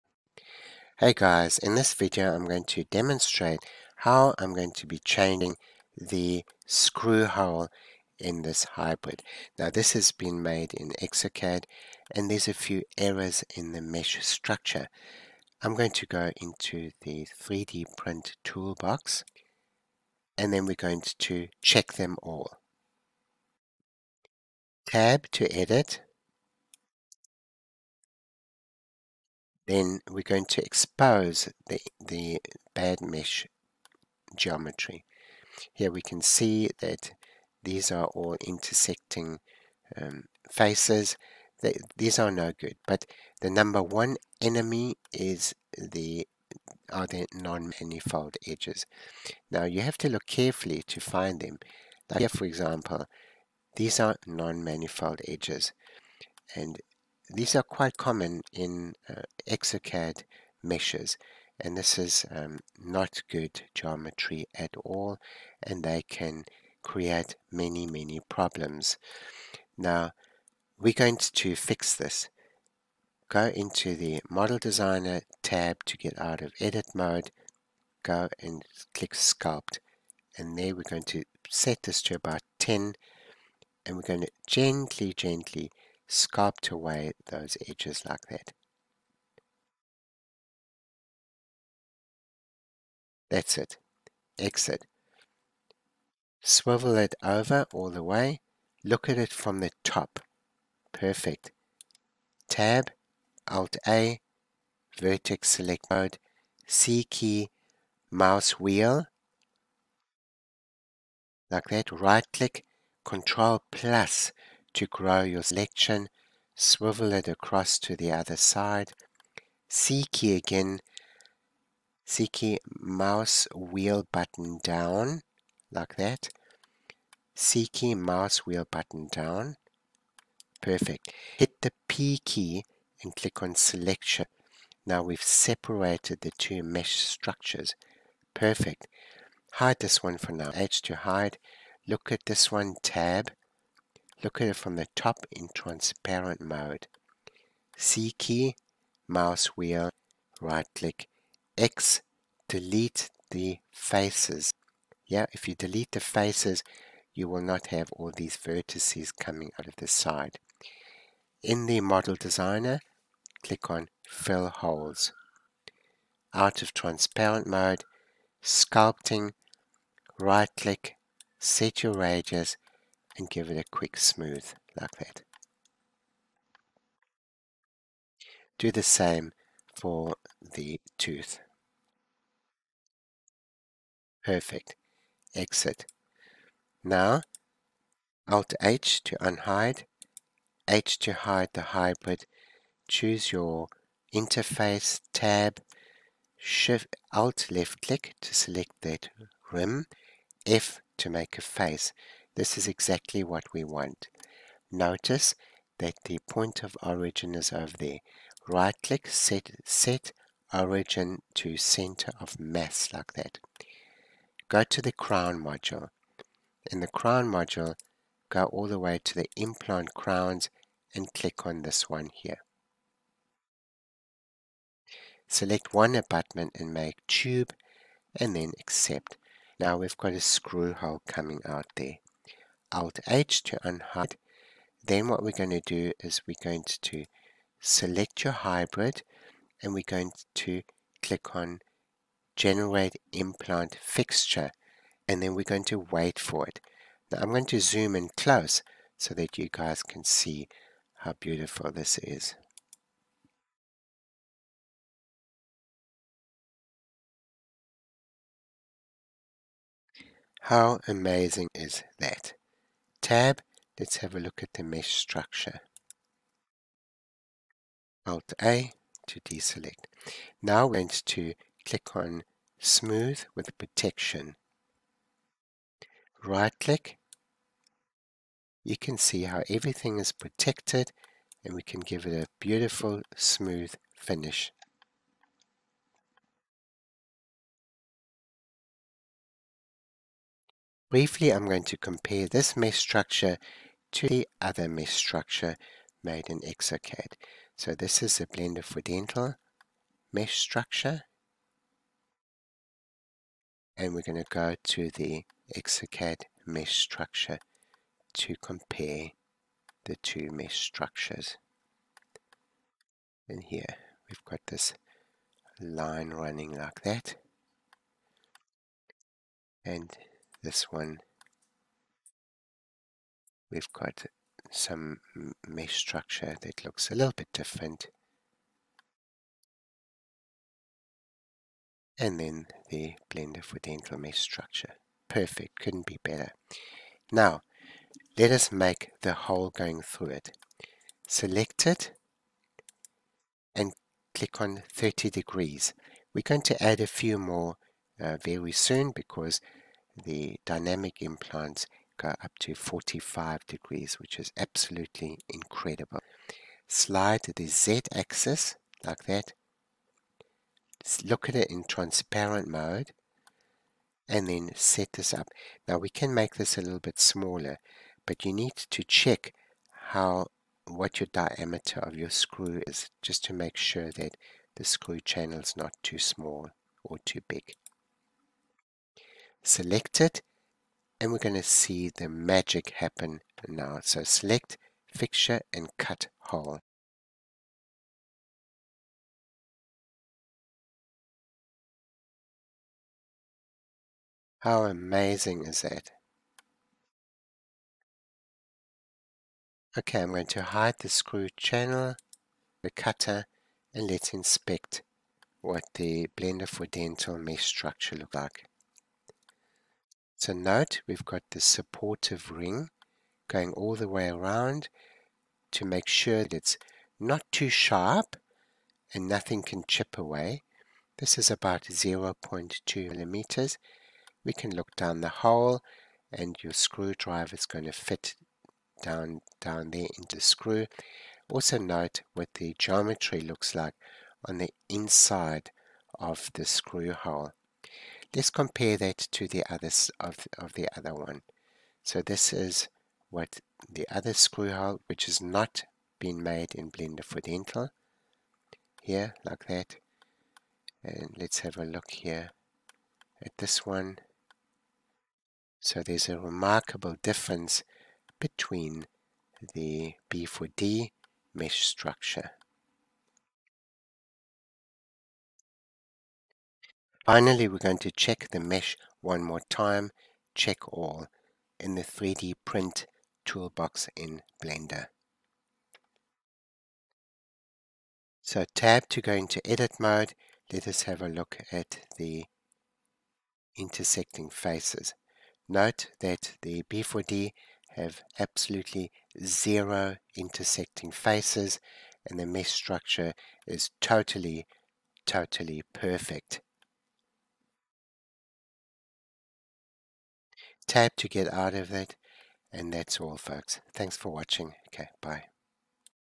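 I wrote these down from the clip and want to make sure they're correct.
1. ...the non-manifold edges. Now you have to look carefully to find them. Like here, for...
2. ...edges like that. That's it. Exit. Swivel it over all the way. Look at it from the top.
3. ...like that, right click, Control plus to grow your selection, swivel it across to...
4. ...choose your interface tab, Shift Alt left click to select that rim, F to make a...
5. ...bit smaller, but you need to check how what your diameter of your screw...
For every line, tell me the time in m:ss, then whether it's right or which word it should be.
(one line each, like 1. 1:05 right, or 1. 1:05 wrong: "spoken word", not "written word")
1. 0:47 right
2. 1:27 right
3. 1:51 right
4. 3:12 right
5. 6:06 right.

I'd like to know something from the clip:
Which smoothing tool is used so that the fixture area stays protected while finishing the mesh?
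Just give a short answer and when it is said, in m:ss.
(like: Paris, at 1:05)
Smooth with Protection, at 4:32.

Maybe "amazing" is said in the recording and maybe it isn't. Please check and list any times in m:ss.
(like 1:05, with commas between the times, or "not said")
4:20, 6:34.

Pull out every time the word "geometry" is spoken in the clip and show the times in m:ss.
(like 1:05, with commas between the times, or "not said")
0:34, 1:03, 7:12.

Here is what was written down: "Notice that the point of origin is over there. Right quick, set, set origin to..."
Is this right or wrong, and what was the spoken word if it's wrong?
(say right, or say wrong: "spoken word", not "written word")
wrong: "click", not "quick".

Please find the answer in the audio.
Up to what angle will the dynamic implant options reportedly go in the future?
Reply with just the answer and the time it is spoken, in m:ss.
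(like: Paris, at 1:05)
45 degrees, at 5:52.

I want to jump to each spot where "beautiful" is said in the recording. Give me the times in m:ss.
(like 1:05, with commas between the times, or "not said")
4:11, 4:42.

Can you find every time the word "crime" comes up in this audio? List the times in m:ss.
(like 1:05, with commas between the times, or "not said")
not said.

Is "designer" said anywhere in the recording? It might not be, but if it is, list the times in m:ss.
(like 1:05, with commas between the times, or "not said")
1:14, 2:42.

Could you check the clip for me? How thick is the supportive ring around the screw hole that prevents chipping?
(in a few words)
0.2 millimeters.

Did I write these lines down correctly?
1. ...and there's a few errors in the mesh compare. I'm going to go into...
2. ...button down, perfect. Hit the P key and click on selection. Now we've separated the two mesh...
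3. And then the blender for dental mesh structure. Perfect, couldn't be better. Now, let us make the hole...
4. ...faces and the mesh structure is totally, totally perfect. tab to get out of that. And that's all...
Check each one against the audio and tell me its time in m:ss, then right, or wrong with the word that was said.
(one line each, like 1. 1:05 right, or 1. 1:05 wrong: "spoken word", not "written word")
1. 0:12 wrong: "structure", not "compare"
2. 2:08 right
3. 5:31 right
4. 8:10 right.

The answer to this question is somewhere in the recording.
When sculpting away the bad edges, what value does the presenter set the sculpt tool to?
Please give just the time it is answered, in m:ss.
1:22.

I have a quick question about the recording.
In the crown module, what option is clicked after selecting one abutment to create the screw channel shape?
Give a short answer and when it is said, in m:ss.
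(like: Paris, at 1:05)
Make tube, at 3:46.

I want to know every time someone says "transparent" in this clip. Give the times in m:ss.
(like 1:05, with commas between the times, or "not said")
2:25, 2:46, 6:01.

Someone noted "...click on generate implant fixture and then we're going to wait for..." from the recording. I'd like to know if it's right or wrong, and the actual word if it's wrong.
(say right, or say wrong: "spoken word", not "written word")
right.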